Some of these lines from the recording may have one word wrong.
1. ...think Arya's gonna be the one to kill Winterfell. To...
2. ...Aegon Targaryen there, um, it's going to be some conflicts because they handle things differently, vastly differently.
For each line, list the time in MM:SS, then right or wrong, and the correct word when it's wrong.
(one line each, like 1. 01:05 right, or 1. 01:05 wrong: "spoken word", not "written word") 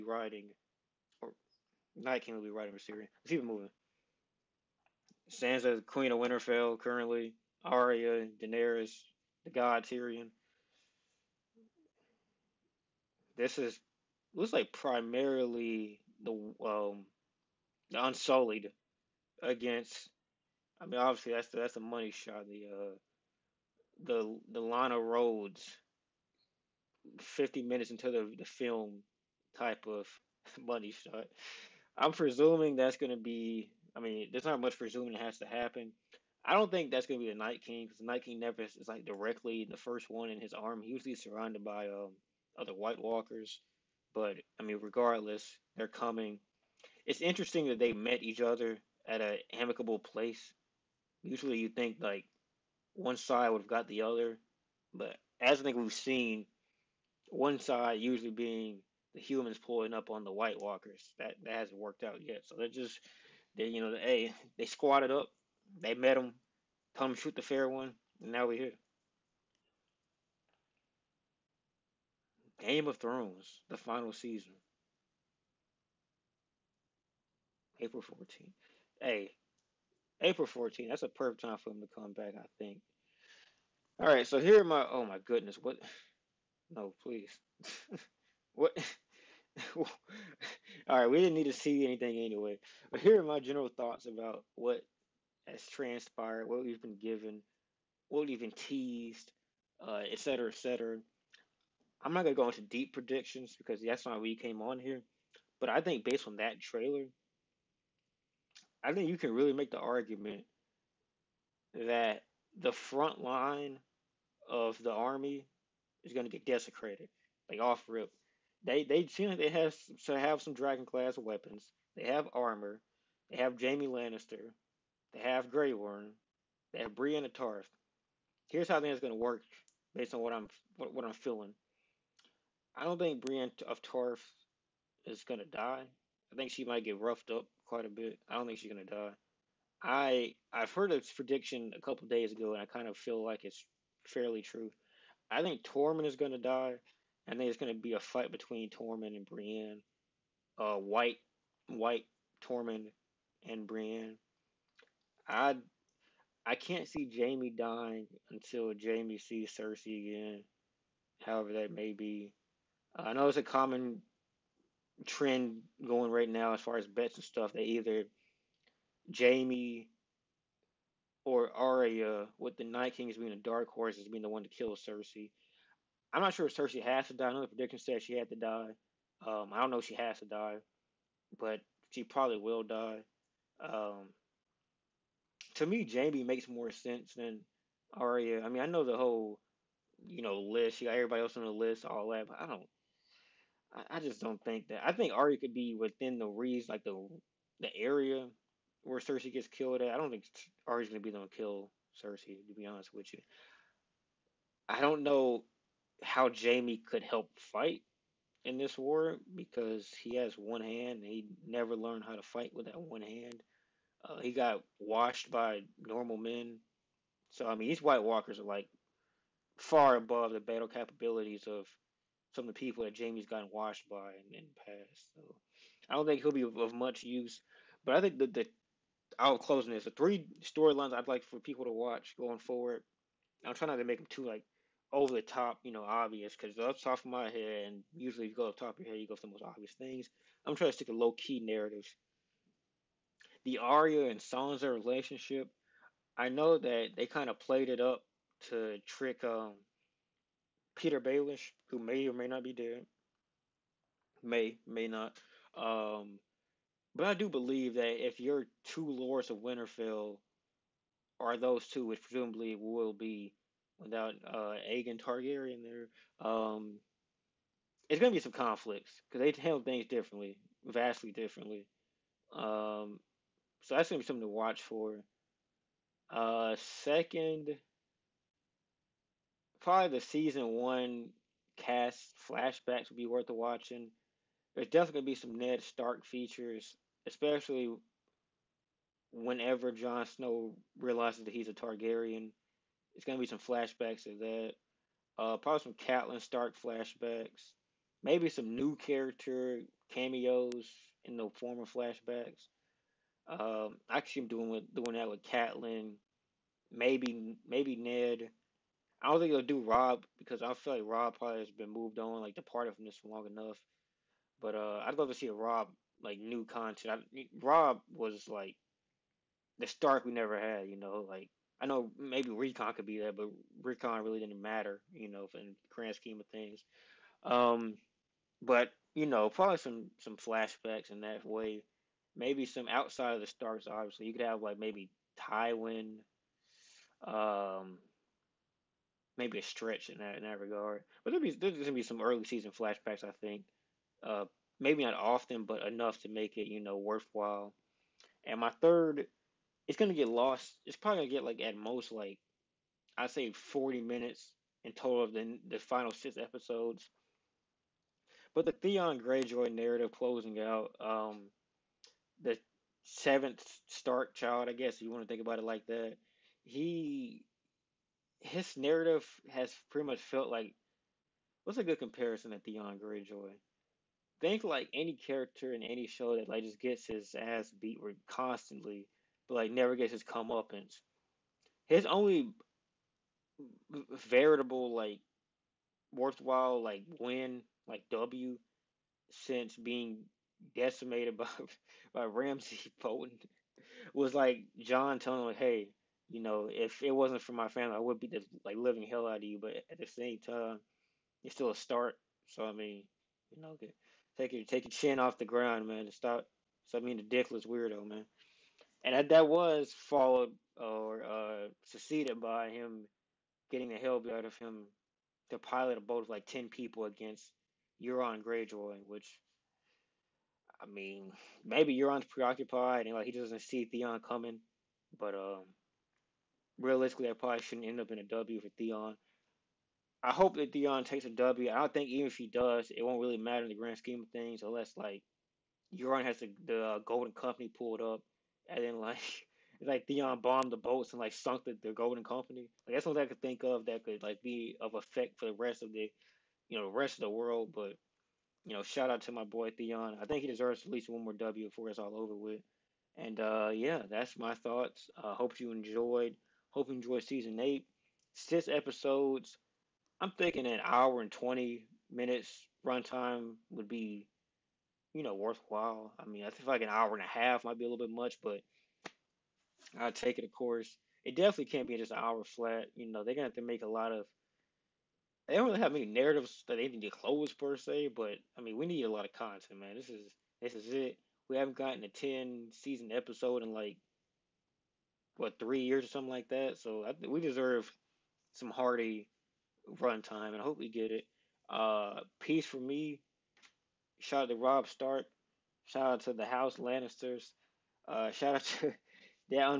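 1. 03:20 wrong: "Cersei", not "Winterfell"
2. 04:24 right.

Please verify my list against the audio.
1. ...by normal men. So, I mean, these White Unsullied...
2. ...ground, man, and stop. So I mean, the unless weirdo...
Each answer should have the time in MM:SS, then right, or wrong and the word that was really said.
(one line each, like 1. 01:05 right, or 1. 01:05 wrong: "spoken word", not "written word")
1. 03:35 wrong: "Walkers", not "Unsullied"
2. 06:45 wrong: "dickless", not "unless".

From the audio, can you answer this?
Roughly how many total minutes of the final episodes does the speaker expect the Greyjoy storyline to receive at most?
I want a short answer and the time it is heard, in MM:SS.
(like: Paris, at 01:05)
40 minutes, at 05:53.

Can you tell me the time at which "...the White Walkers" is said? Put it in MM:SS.
01:00.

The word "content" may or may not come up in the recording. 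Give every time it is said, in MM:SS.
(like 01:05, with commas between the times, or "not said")
05:16, 07:59.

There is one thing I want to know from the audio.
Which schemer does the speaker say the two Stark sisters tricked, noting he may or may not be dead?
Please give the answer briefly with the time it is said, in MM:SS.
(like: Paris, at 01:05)
Petyr Baelish, at 04:10.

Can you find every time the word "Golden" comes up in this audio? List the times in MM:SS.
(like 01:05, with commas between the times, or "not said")
07:16, 07:21.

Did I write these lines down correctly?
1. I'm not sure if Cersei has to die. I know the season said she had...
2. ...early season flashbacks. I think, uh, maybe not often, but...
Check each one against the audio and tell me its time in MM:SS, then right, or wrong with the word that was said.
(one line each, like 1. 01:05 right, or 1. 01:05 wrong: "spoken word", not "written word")
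1. 02:56 wrong: "prediction", not "season"
2. 05:42 right.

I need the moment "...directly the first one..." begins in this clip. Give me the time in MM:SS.
00:39.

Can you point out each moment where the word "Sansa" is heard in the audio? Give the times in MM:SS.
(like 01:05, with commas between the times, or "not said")
00:05, 04:04.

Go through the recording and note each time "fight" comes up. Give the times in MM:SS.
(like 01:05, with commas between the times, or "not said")
02:27, 03:27, 03:32.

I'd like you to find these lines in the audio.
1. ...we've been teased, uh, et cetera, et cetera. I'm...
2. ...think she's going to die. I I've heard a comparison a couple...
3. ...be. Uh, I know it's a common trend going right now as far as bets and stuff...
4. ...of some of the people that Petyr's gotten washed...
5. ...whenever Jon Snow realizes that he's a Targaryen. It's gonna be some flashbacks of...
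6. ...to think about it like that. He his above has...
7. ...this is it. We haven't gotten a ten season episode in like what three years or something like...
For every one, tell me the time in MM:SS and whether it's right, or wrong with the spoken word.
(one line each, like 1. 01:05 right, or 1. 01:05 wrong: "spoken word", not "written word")
1. 01:38 right
2. 02:18 wrong: "prediction", not "comparison"
3. 02:41 right
4. 03:41 wrong: "Jaime", not "Petyr"
5. 04:49 right
6. 06:05 wrong: "narrative", not "above"
7. 08:00 right.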